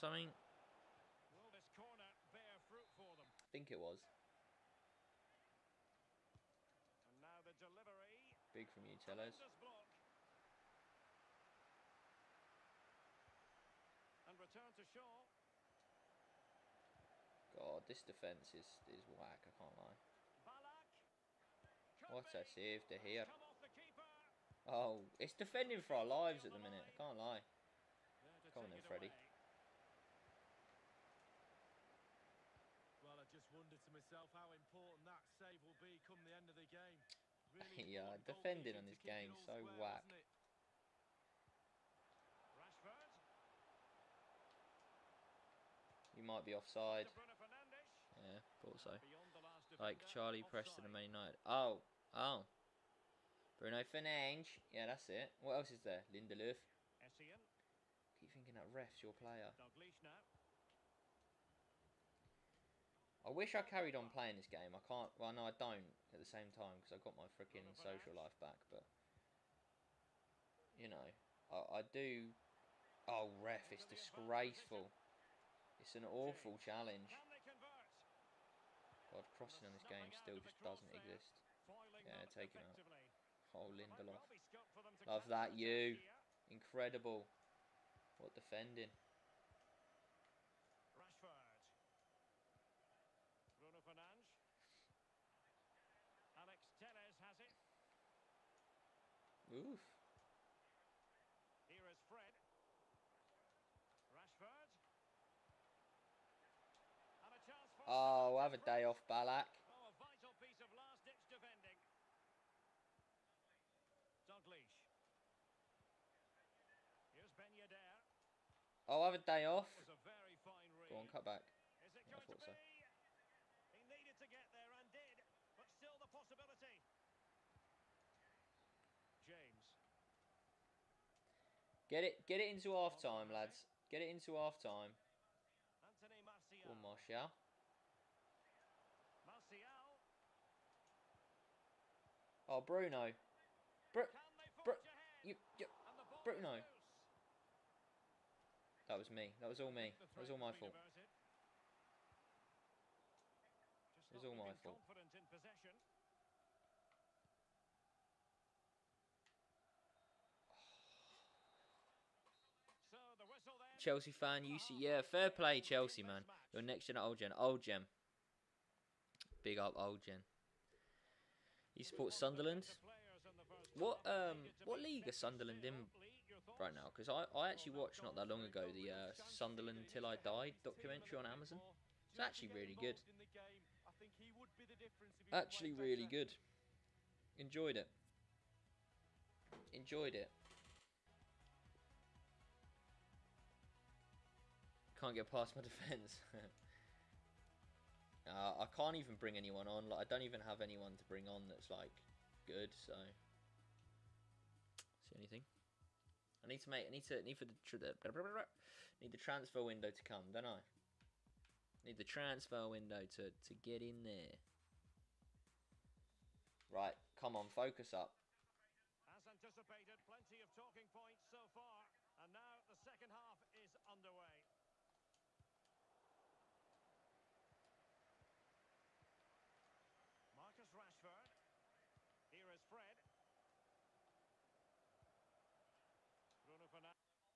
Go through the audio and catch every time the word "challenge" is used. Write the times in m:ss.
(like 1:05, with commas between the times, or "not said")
1:16.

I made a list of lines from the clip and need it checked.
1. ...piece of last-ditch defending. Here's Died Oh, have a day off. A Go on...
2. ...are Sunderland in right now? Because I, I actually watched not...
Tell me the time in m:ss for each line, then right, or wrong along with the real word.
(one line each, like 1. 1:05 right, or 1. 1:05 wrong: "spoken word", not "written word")
1. 1:50 wrong: "Ben", not "Died"
2. 2:55 right.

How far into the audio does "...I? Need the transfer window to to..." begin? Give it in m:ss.
3:30.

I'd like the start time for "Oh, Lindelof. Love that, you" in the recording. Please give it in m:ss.
1:23.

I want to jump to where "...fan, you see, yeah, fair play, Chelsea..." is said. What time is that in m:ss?
2:44.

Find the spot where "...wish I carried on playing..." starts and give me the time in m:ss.
1:03.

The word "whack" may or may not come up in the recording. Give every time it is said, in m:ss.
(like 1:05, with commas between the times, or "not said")
0:19, 0:39.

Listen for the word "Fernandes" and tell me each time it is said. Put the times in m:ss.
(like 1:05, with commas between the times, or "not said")
0:53, 1:33.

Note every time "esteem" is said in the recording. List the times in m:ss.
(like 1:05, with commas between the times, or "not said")
not said.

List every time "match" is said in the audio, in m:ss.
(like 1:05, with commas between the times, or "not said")
not said.